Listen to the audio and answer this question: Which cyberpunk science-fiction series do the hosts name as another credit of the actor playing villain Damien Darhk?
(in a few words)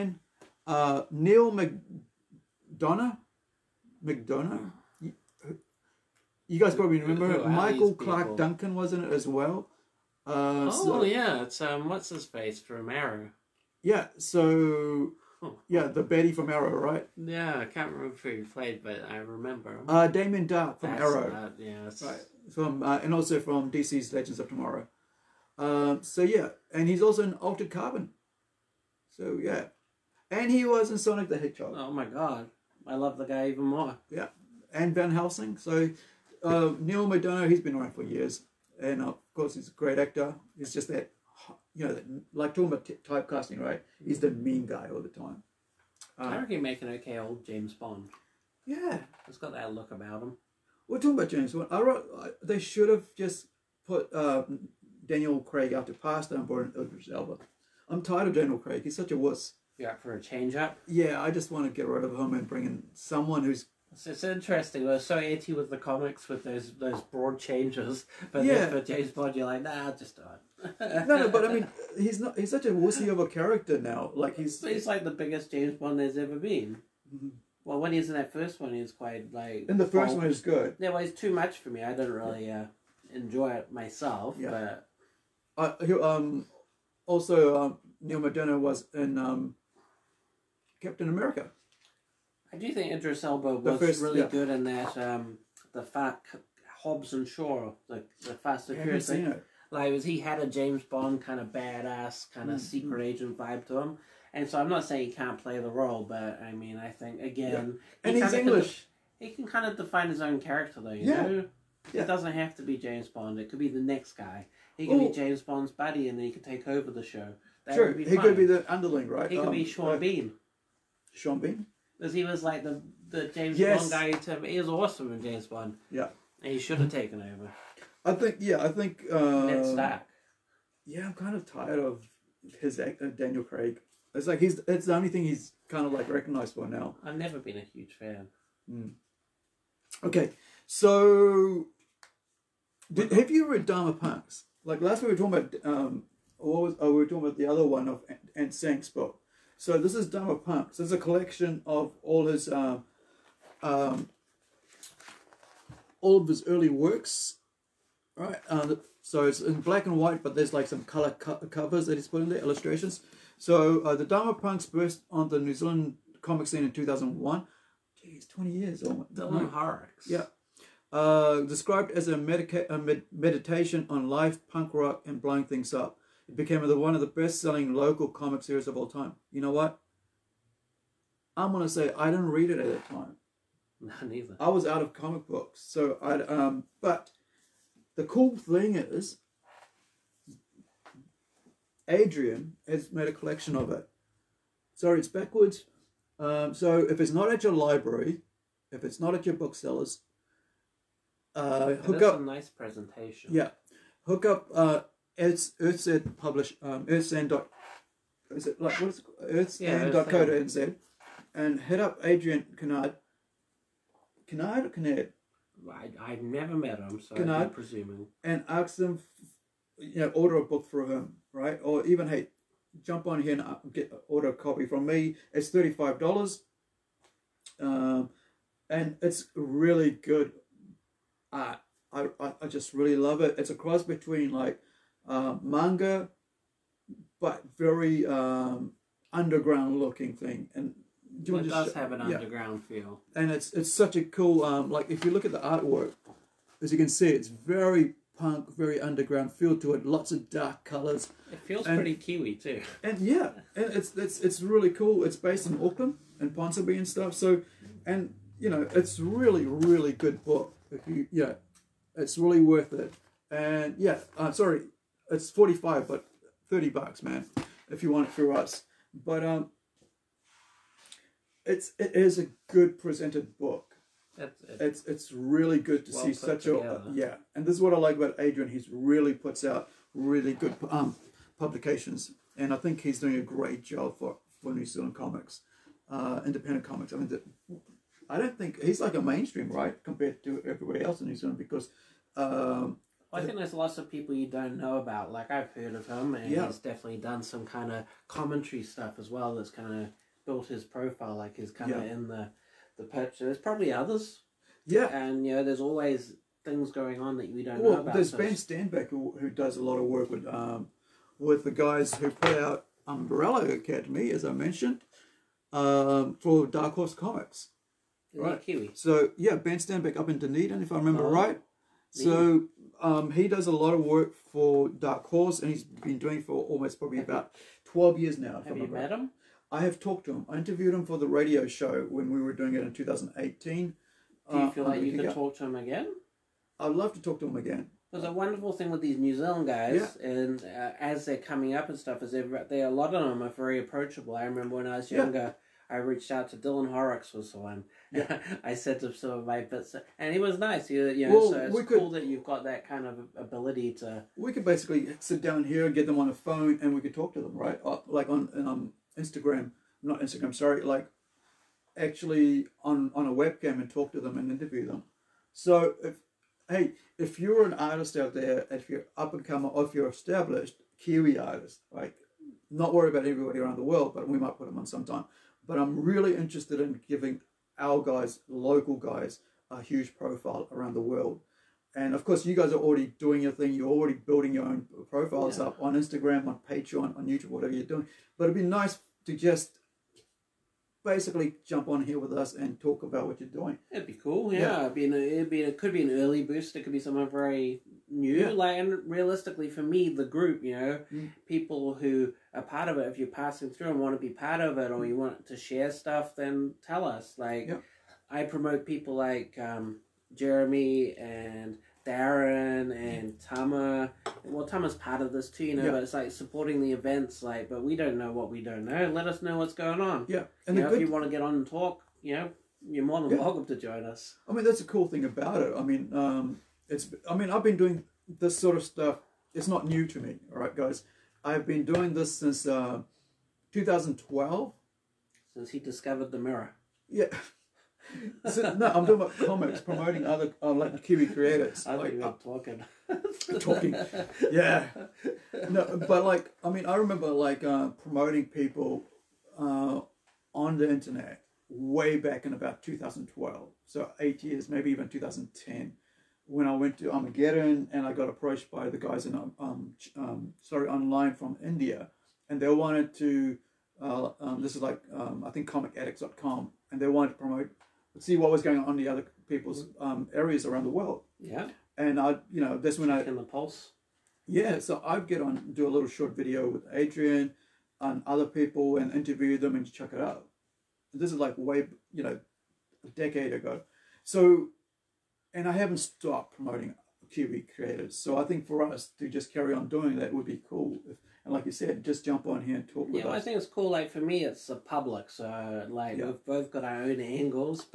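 Altered Carbon.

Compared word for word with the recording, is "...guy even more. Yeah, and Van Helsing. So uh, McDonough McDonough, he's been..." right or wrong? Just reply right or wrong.
wrong.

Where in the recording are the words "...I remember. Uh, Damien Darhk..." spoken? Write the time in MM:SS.
00:19.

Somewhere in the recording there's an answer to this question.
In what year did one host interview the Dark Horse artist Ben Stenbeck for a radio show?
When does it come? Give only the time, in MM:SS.
05:32.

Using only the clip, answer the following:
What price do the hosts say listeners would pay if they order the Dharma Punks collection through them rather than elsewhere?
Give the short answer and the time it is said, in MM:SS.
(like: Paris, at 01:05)
$30, at 04:26.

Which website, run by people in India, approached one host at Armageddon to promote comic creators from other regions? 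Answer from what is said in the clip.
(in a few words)
ComicAddicts.com.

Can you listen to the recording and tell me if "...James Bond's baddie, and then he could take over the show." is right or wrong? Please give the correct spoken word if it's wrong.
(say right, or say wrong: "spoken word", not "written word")
right.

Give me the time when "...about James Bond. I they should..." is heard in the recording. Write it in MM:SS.
00:51.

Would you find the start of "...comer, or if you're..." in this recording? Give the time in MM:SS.
06:09.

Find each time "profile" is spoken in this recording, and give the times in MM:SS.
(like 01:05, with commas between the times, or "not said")
05:00, 06:19, 06:24.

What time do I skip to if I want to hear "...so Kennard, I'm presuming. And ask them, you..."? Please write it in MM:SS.
03:37.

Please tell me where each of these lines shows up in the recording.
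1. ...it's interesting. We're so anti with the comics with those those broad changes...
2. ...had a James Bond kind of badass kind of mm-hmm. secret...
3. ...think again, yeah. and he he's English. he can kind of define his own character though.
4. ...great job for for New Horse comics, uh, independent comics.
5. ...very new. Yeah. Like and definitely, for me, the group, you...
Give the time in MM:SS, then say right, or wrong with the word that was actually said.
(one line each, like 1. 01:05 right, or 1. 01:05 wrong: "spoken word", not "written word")
1. 01:04 right
2. 01:40 right
3. 01:46 right
4. 04:43 wrong: "Zealand", not "Horse"
5. 06:37 wrong: "realistically", not "definitely".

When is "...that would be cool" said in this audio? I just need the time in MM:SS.
08:09.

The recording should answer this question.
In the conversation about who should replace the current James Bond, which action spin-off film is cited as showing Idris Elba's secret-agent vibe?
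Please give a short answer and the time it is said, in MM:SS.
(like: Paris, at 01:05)
Hobbs and Shaw, at 01:36.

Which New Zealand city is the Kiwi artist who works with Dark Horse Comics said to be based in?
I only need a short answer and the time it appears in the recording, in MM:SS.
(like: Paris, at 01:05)
Dunedin, at 05:20.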